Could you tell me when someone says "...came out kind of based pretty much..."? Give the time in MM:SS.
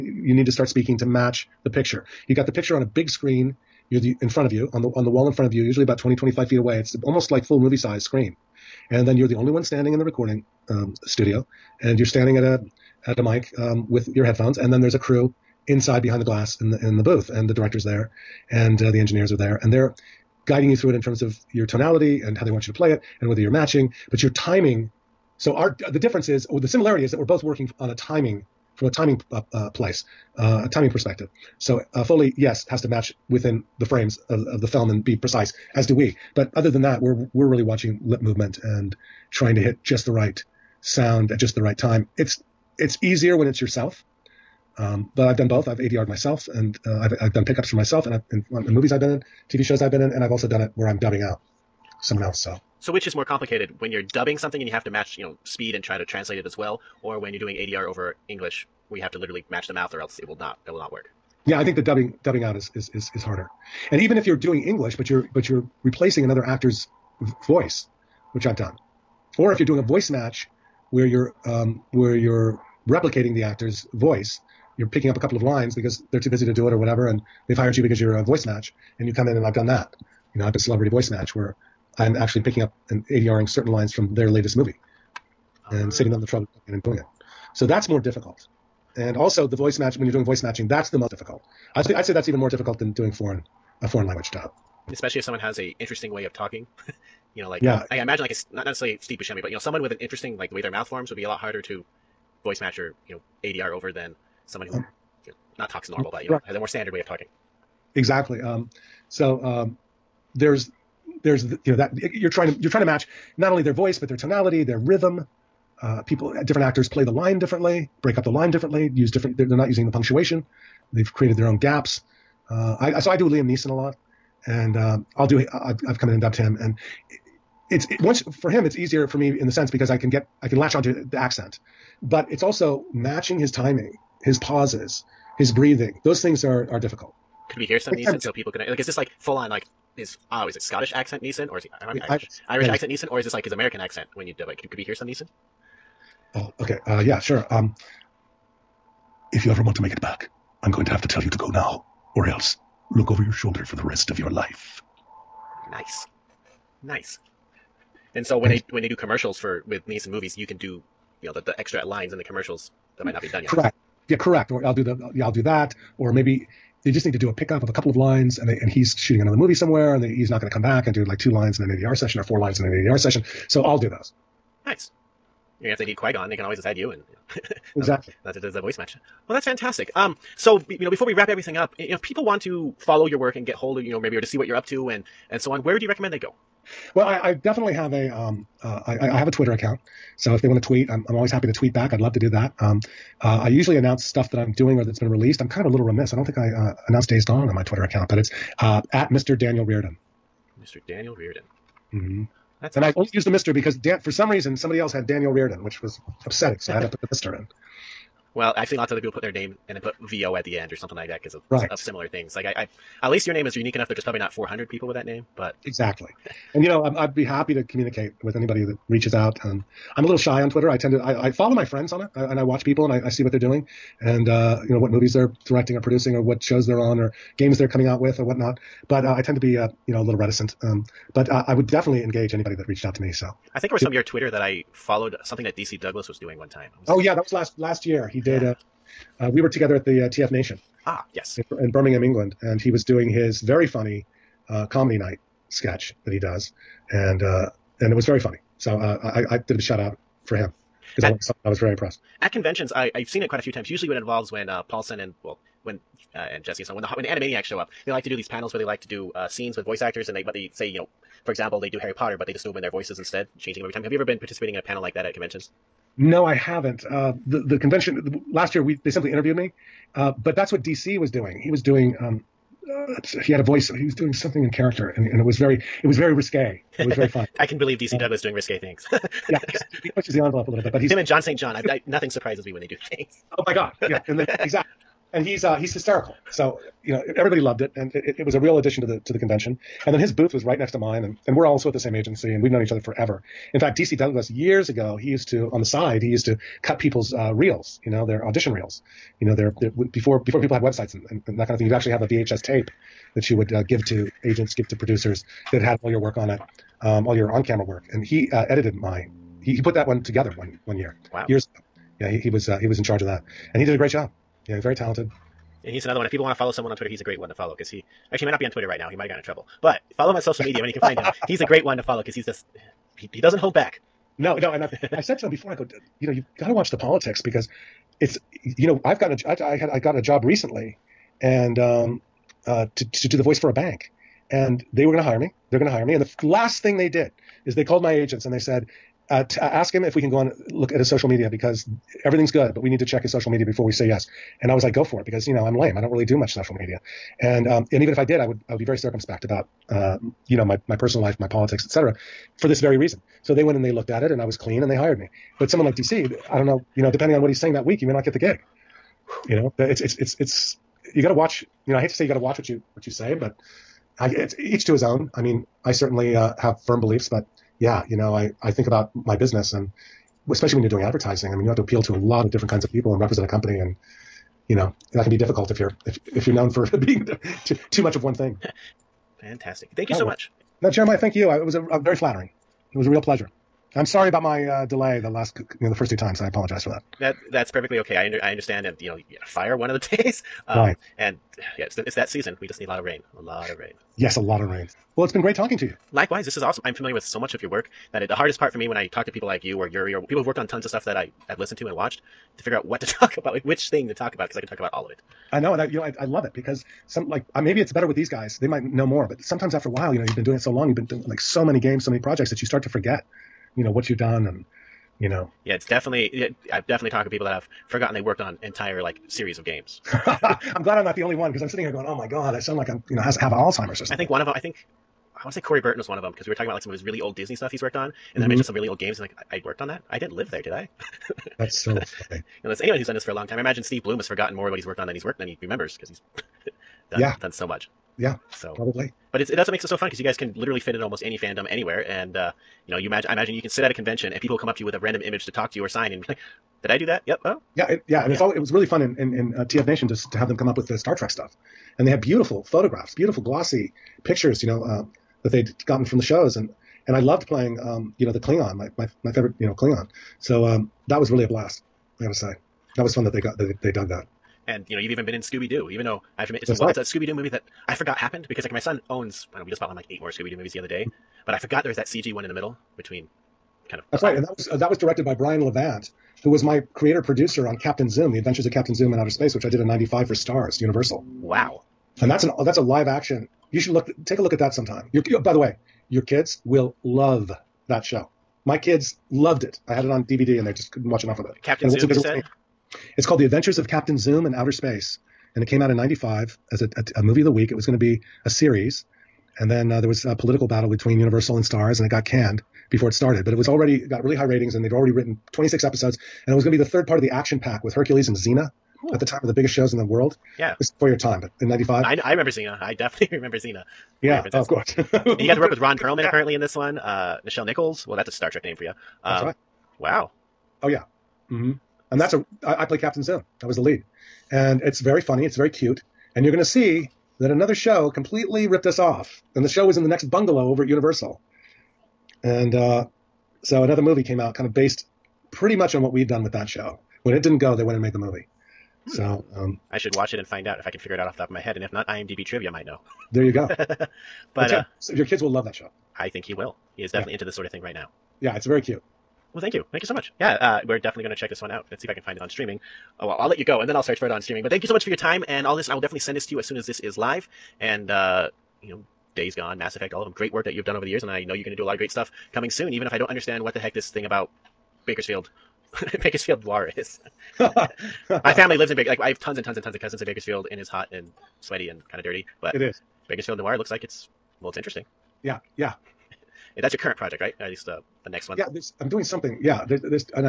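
08:54.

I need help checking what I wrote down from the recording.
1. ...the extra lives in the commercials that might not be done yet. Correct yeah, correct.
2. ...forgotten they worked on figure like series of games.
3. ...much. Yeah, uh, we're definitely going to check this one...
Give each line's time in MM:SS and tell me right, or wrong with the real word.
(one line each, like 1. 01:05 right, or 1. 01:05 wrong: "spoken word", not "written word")
1. 02:41 wrong: "lines", not "lives"
2. 06:57 wrong: "entire", not "figure"
3. 09:09 right.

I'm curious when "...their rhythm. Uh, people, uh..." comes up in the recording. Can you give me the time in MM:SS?
01:54.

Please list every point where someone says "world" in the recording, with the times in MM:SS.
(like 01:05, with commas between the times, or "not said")
08:29.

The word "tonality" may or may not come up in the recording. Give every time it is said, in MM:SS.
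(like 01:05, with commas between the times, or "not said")
00:21, 01:54.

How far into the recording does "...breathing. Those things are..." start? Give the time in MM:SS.
02:15.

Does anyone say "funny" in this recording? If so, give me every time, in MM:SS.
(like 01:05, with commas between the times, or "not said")
04:03, 04:08, 04:37, 07:12, 08:45.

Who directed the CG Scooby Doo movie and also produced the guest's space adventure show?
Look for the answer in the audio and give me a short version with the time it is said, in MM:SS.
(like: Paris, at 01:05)
Brian Levant, at 07:55.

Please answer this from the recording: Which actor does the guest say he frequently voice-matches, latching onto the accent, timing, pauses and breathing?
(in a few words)
Liam Neeson.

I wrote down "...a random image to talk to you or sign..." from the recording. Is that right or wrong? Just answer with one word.
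right.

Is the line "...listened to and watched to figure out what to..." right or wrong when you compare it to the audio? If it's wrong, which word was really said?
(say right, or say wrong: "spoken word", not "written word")
right.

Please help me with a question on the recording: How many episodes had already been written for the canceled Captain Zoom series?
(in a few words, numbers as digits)
26.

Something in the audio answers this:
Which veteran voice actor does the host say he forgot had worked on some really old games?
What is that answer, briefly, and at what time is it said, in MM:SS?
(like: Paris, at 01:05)
Corey Burton, at 07:05.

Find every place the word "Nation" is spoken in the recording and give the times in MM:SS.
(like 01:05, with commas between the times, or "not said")
04:00, 07:29.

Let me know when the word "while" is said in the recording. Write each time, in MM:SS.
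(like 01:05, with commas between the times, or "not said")
06:49.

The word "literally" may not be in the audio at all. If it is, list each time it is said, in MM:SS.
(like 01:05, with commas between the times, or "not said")
00:59, 07:20.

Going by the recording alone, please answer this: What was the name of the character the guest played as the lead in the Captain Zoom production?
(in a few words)
Captain Zim.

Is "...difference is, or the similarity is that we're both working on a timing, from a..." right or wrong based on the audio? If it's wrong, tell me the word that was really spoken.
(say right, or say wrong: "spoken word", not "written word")
right.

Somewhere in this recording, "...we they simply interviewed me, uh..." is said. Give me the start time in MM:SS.
04:28.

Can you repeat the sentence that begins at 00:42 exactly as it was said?
It's it's easier when it's yourself.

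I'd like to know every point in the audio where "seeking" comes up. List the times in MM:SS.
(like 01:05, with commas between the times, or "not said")
not said.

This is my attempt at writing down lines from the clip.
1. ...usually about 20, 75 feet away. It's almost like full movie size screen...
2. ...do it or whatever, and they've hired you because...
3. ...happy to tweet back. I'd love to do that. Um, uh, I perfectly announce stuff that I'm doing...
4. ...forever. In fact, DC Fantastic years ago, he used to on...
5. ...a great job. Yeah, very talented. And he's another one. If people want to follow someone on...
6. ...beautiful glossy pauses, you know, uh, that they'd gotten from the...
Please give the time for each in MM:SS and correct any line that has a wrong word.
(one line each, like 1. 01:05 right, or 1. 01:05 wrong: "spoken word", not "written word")
1. 00:05 wrong: "25", not "75"
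2. 01:16 right
3. 03:11 wrong: "usually", not "perfectly"
4. 04:52 wrong: "Douglas", not "Fantastic"
5. 05:13 right
6. 07:32 wrong: "pictures", not "pauses".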